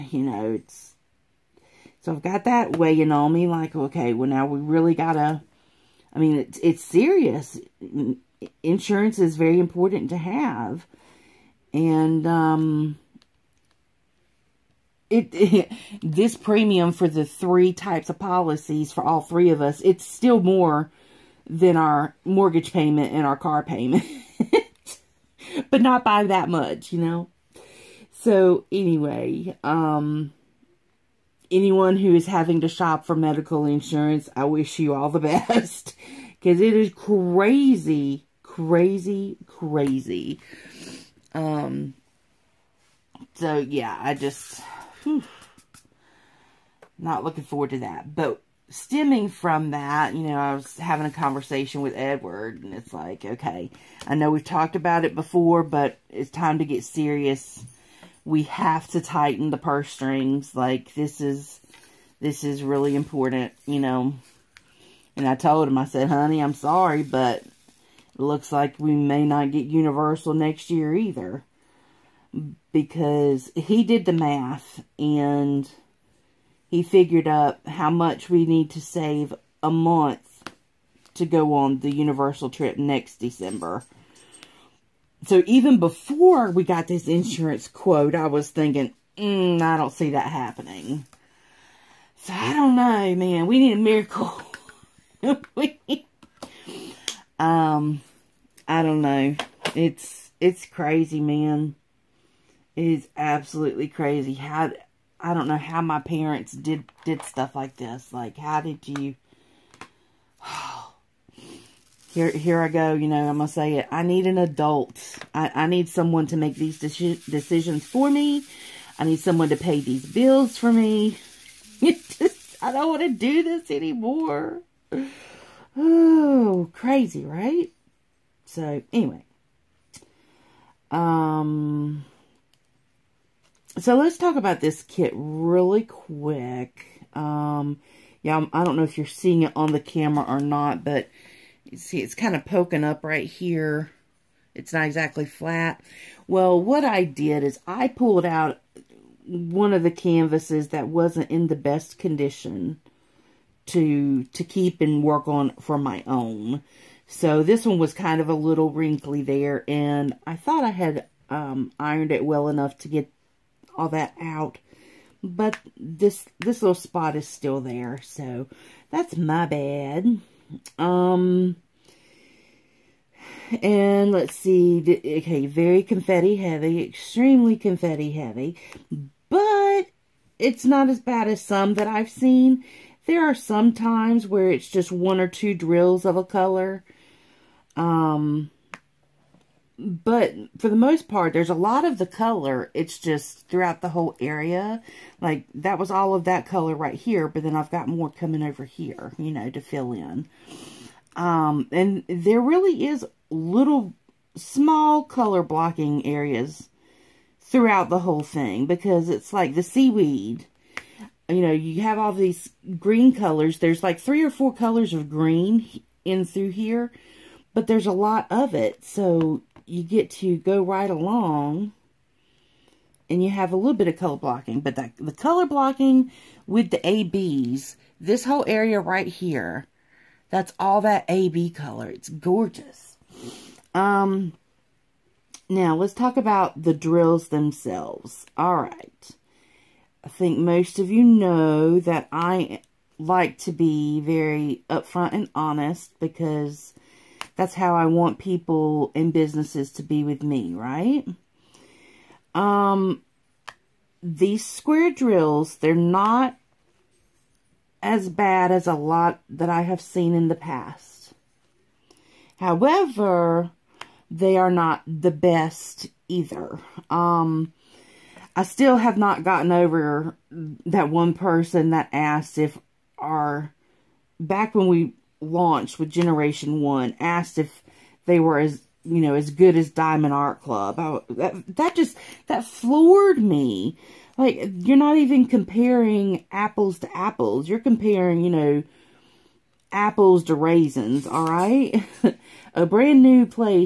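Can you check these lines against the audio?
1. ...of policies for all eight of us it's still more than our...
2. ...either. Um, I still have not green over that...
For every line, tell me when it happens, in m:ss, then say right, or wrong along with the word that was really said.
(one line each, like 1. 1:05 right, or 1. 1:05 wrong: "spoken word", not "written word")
1. 0:18 wrong: "three", not "eight"
2. 4:26 wrong: "gotten", not "green".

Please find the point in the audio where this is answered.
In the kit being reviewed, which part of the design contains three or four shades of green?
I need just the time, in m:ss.
3:29.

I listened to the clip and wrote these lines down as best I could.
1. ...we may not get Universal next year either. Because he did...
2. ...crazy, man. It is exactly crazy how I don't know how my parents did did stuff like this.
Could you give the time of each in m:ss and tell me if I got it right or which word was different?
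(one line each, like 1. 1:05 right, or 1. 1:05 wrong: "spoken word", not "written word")
1. 1:08 right
2. 1:40 wrong: "absolutely", not "exactly".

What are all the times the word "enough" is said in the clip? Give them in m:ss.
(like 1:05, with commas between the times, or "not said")
2:42.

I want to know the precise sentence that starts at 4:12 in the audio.
Um, these square drills, they're not as bad as a lot that I have seen in the past.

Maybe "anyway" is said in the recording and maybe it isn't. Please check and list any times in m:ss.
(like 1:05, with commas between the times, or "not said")
0:28, 2:08.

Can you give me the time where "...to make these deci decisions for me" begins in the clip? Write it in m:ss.
1:56.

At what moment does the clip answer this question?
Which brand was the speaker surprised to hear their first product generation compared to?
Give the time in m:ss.
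4:39.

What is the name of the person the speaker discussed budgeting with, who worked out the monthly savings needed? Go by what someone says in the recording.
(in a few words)
Edward.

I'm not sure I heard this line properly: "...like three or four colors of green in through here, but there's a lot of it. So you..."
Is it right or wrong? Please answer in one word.
right.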